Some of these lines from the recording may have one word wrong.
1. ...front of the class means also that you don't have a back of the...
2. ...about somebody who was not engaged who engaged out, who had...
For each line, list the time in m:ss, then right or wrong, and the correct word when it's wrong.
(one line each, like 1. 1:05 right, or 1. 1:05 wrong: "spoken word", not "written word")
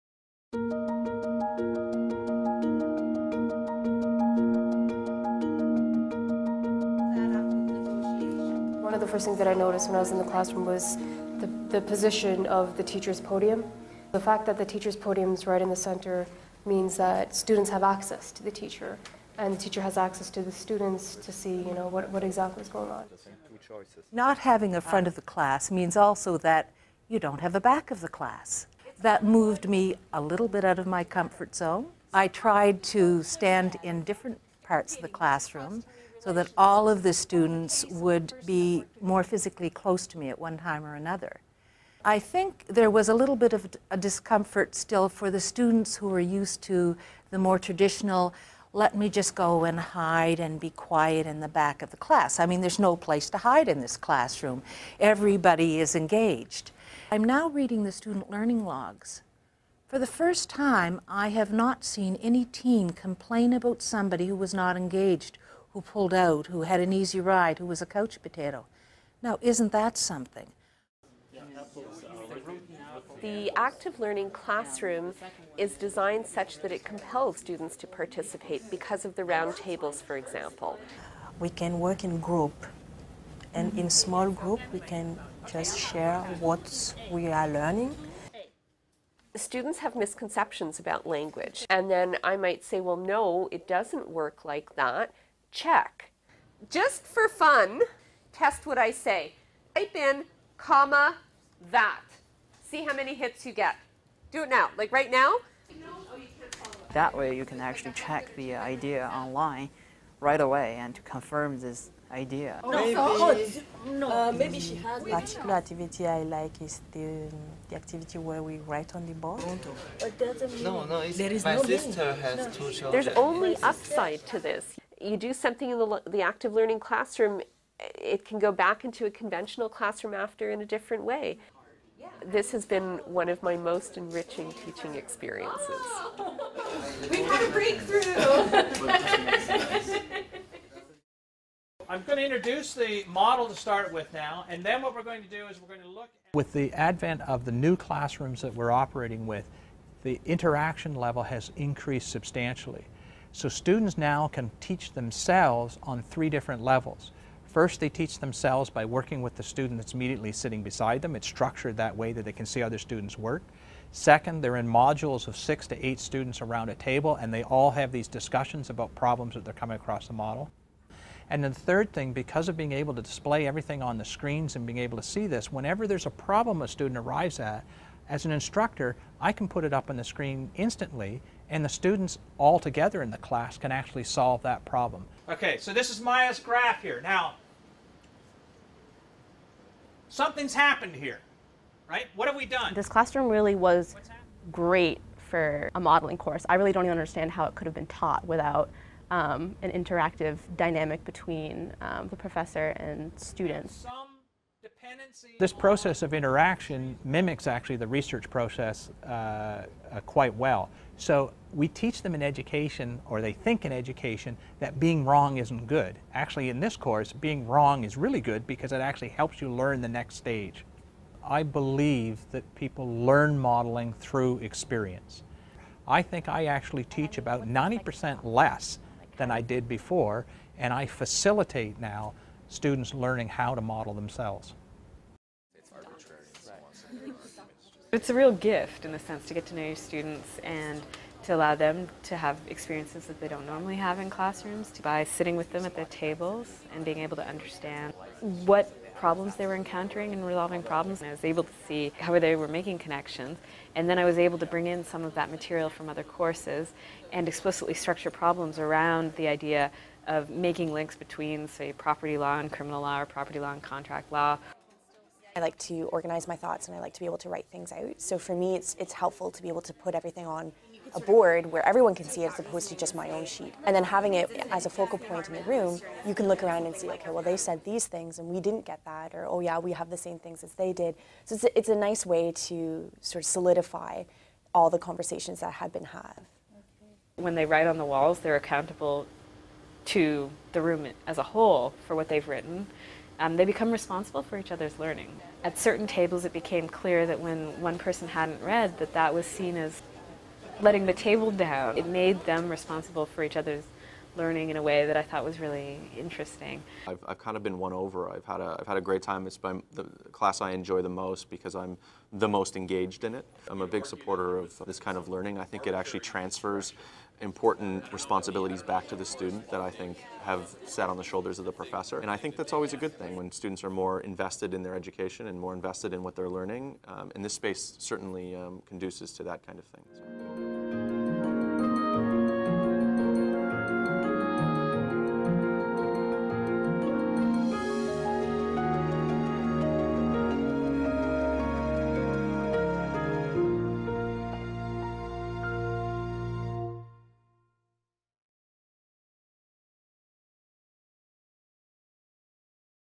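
1. 0:24 right
2. 1:03 wrong: "pulled", not "engaged".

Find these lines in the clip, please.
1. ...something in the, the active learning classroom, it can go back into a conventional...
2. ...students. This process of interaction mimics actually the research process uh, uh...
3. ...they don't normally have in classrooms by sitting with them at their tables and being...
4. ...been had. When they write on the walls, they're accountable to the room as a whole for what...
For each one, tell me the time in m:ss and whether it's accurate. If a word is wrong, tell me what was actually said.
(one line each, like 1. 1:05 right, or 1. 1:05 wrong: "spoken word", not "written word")
1. 2:05 right
2. 3:23 right
3. 4:03 right
4. 4:45 right.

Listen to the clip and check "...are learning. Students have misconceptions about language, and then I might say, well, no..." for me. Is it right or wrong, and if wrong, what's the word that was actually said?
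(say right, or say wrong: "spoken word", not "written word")
right.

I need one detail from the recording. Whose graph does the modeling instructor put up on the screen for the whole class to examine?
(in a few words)
Maya's.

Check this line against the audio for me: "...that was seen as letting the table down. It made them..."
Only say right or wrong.
right.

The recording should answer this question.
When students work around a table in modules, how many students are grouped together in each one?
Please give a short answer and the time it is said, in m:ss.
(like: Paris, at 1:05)
6 to 8, at 2:45.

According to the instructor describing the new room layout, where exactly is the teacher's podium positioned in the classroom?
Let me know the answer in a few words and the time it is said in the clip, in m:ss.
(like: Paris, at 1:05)
right in the center, at 0:15.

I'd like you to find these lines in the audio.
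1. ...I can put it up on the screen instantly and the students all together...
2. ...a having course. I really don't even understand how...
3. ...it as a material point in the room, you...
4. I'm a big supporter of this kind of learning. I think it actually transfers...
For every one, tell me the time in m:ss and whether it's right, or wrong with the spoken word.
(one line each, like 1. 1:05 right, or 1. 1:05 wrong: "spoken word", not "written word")
1. 2:59 right
2. 3:15 wrong: "modeling", not "having"
3. 4:34 wrong: "focal", not "material"
4. 5:13 right.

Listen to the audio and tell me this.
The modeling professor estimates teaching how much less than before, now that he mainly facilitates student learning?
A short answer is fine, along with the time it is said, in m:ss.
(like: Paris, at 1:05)
90%, at 3:47.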